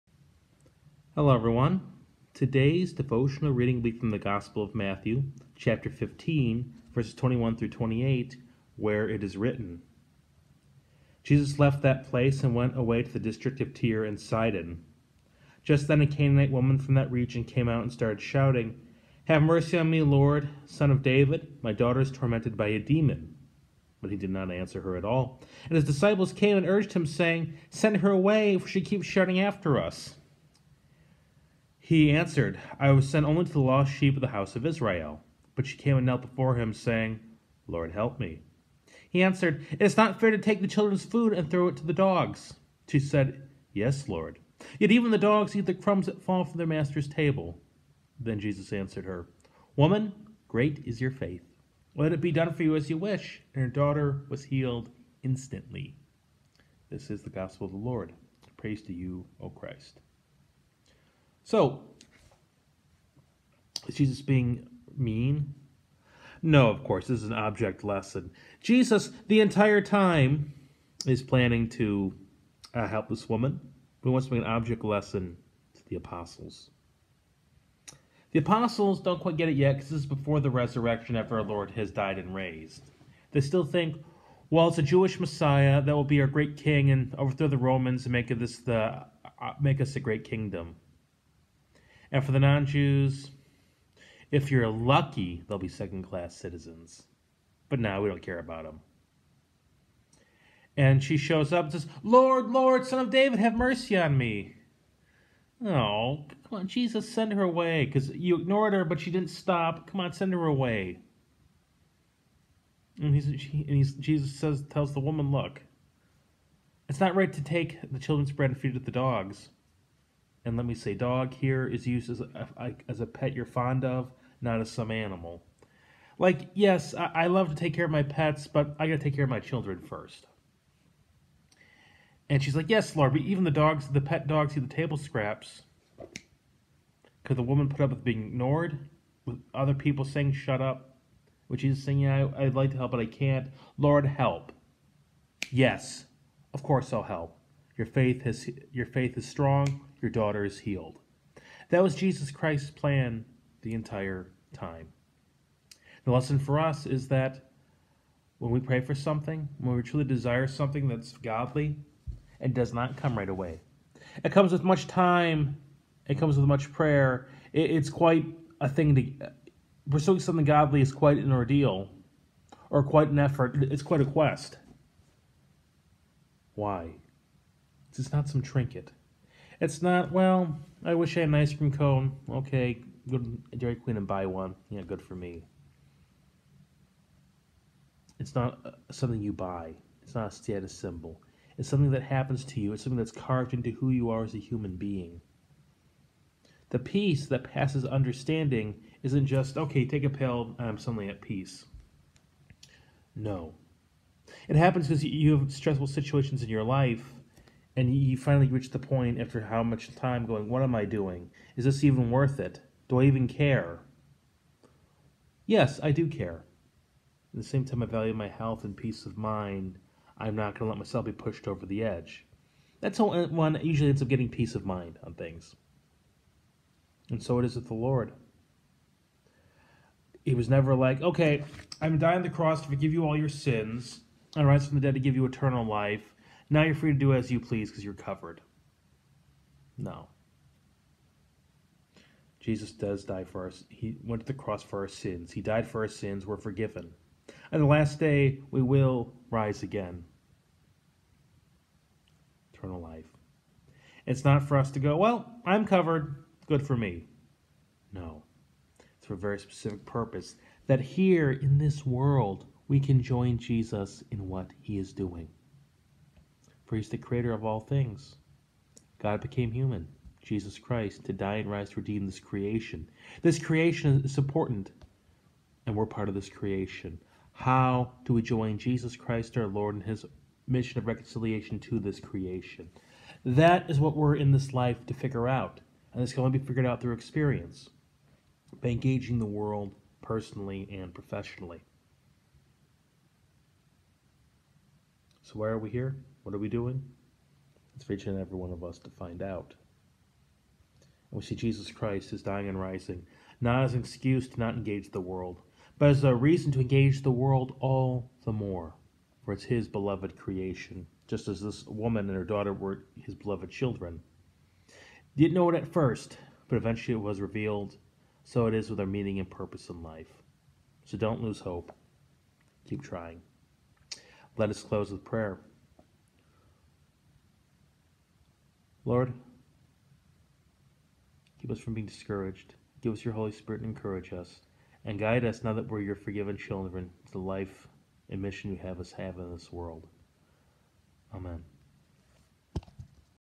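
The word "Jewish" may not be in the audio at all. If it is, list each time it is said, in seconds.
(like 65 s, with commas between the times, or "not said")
84 s.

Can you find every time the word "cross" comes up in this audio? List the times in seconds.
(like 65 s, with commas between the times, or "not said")
232 s, 244 s.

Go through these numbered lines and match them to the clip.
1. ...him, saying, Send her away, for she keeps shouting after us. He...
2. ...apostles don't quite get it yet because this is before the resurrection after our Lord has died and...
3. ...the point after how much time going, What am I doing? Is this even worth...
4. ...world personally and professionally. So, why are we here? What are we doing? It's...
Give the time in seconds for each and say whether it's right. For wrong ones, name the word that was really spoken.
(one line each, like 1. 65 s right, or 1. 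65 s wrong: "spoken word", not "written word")
1. 26 s right
2. 78 s right
3. 208 s right
4. 289 s right.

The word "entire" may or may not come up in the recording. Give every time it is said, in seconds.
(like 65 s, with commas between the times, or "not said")
69 s, 153 s.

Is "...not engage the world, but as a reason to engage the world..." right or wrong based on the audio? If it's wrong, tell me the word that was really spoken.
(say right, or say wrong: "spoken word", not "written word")
right.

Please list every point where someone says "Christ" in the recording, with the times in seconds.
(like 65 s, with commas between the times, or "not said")
59 s, 152 s, 270 s, 278 s, 301 s.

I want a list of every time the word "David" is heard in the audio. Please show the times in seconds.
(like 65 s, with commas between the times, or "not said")
21 s, 103 s.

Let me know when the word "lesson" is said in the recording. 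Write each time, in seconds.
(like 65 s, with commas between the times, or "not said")
67 s, 74 s, 156 s.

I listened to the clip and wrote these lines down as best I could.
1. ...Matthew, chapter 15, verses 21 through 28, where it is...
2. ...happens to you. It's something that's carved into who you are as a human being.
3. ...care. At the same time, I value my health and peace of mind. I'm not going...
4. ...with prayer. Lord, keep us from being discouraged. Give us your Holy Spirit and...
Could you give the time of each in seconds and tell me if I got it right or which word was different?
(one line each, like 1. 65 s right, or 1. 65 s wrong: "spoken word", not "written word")
1. 4 s right
2. 192 s right
3. 216 s right
4. 324 s right.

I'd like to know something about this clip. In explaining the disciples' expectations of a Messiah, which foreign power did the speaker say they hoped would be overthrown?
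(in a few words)
The Romans.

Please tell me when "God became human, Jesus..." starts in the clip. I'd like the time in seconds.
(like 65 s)
268 s.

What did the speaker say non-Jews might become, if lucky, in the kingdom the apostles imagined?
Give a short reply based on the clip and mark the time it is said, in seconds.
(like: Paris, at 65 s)
Second class citizens, at 95 s.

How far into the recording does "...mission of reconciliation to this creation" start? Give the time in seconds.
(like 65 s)
280 s.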